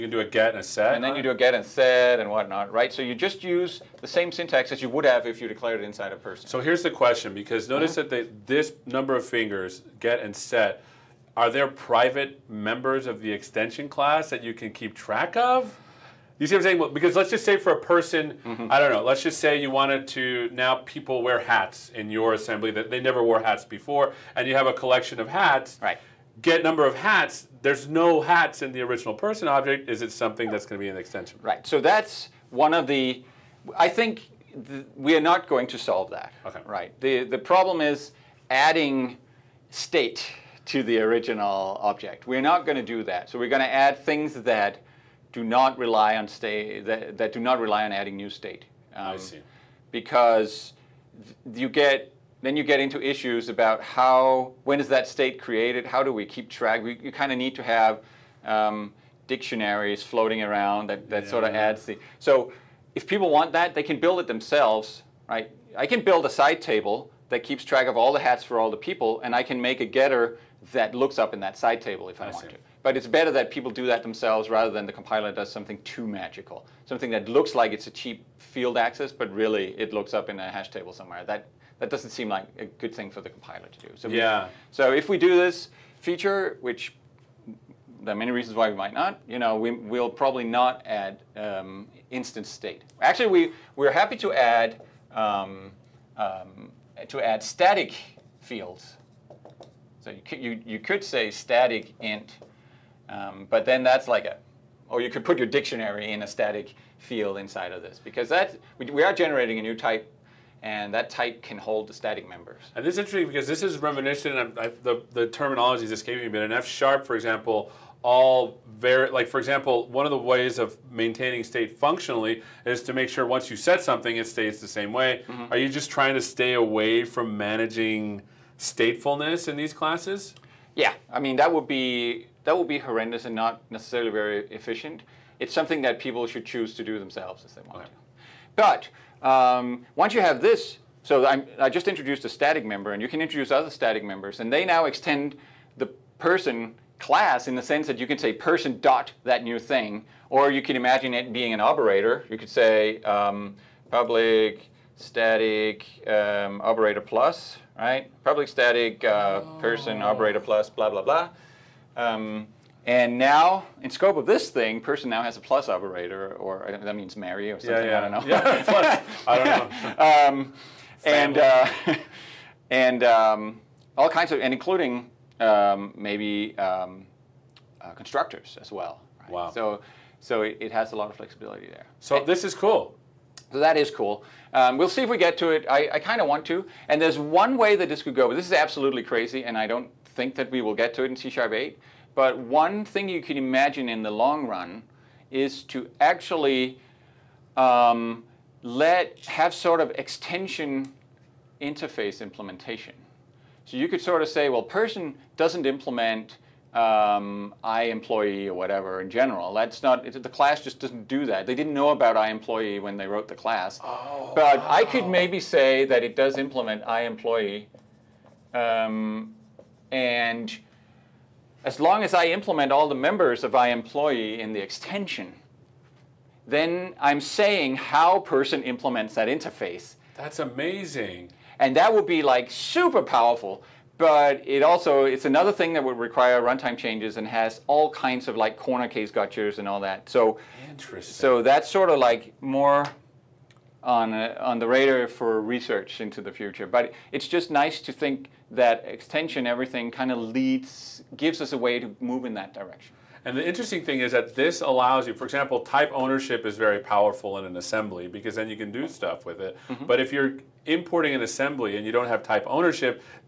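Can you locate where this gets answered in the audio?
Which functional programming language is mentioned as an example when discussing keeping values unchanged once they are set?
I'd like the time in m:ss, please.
1:56.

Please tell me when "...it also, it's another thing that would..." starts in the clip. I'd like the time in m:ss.
3:54.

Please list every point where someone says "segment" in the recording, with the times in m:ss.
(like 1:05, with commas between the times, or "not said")
not said.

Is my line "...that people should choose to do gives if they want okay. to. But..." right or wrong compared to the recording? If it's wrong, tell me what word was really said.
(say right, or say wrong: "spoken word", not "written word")
wrong: "themselves", not "gives".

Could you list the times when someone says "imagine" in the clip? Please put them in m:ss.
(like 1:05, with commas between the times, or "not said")
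2:30, 3:13.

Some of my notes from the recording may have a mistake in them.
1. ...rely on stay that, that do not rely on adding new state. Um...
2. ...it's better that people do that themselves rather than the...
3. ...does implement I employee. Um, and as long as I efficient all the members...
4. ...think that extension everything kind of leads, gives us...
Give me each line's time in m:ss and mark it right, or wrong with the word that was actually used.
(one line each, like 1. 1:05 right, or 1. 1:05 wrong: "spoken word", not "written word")
1. 0:45 right
2. 1:12 right
3. 3:36 wrong: "implement", not "efficient"
4. 4:07 right.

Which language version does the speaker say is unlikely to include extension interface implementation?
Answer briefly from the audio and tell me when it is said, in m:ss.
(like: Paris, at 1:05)
C# 8, at 3:11.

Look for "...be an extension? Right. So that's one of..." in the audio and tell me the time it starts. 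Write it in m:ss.
0:30.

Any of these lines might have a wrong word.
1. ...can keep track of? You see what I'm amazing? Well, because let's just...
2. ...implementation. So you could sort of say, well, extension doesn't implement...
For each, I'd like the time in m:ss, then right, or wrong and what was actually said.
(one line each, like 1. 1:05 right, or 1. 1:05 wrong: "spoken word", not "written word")
1. 0:14 wrong: "saying", not "amazing"
2. 3:22 wrong: "person", not "extension".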